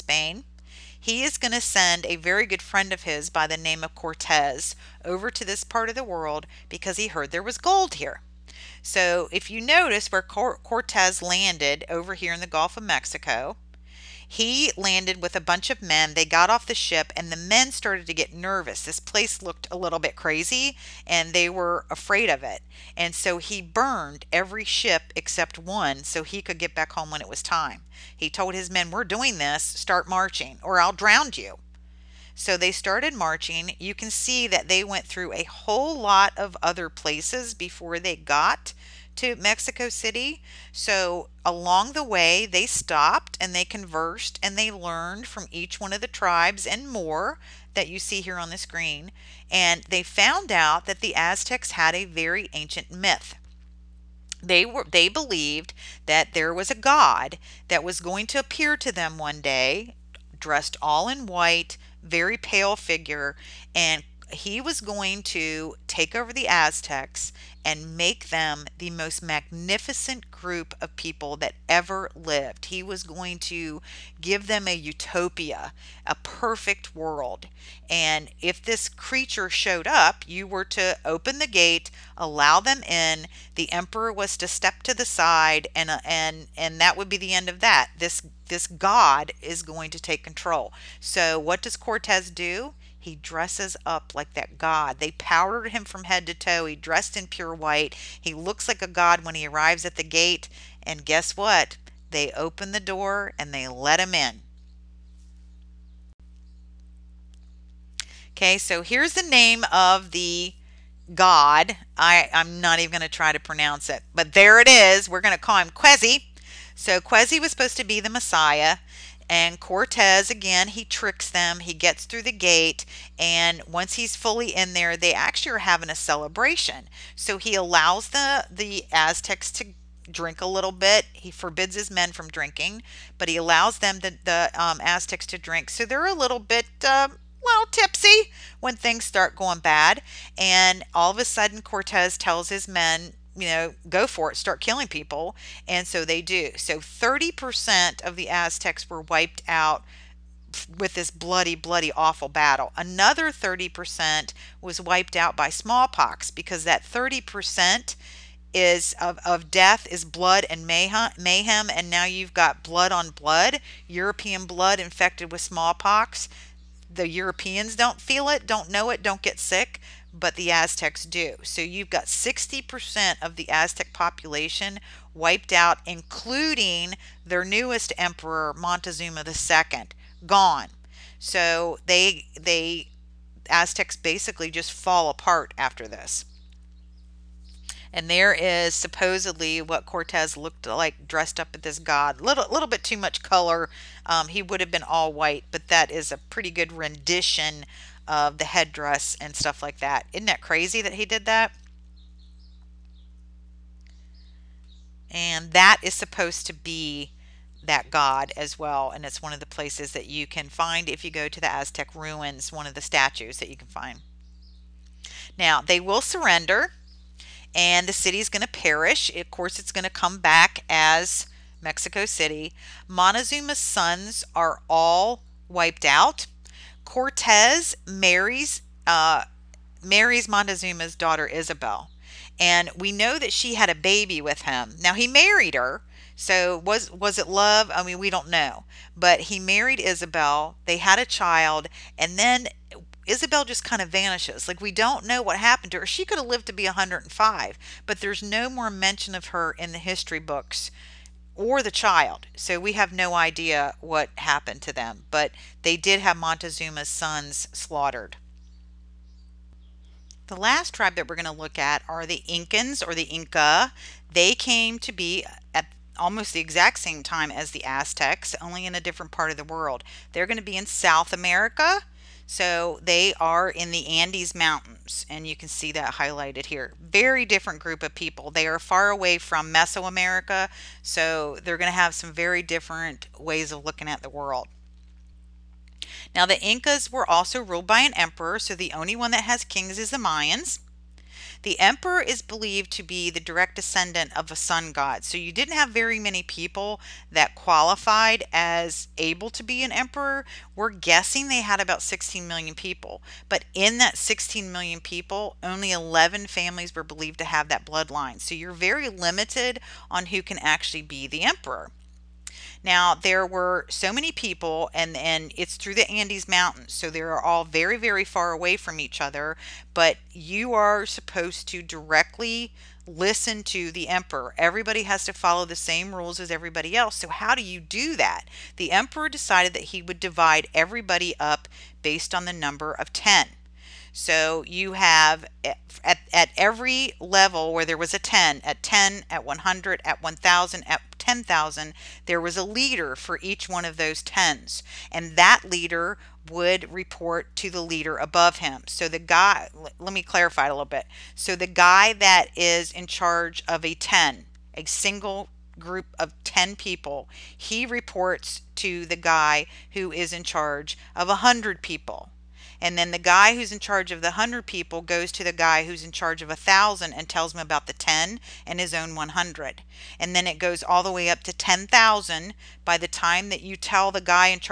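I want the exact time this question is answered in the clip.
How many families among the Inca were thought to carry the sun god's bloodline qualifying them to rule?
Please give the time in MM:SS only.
05:05.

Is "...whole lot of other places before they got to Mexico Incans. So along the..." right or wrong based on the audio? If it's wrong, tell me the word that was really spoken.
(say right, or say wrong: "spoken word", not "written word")
wrong: "City", not "Incans".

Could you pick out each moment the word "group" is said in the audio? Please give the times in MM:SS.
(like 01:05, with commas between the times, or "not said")
01:10, 04:37, 05:55.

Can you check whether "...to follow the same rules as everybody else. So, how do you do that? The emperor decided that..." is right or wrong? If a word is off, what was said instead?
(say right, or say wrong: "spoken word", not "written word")
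right.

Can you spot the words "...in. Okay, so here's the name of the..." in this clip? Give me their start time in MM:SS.
01:44.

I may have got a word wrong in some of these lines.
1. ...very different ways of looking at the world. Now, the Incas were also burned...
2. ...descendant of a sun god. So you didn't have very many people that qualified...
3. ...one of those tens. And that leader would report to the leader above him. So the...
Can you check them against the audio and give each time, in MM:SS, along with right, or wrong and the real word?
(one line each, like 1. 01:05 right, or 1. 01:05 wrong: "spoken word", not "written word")
1. 04:42 wrong: "ruled", not "burned"
2. 04:53 right
3. 05:43 right.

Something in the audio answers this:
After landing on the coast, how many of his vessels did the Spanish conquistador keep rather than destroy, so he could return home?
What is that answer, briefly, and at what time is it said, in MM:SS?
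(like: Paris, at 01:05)
1, at 00:24.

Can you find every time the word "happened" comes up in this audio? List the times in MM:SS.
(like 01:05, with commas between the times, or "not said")
04:05, 04:14.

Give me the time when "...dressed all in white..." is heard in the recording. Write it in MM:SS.
01:00.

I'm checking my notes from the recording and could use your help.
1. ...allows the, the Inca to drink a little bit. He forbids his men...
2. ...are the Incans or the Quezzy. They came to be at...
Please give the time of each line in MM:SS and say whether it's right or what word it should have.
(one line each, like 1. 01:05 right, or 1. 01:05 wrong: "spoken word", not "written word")
1. 02:07 wrong: "Aztecs", not "Inca"
2. 04:21 wrong: "Inca", not "Quezzy".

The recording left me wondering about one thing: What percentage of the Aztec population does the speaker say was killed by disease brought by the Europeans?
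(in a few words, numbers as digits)
30%.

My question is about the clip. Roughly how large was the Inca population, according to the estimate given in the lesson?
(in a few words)
16 million.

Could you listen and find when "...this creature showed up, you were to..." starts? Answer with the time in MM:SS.
01:18.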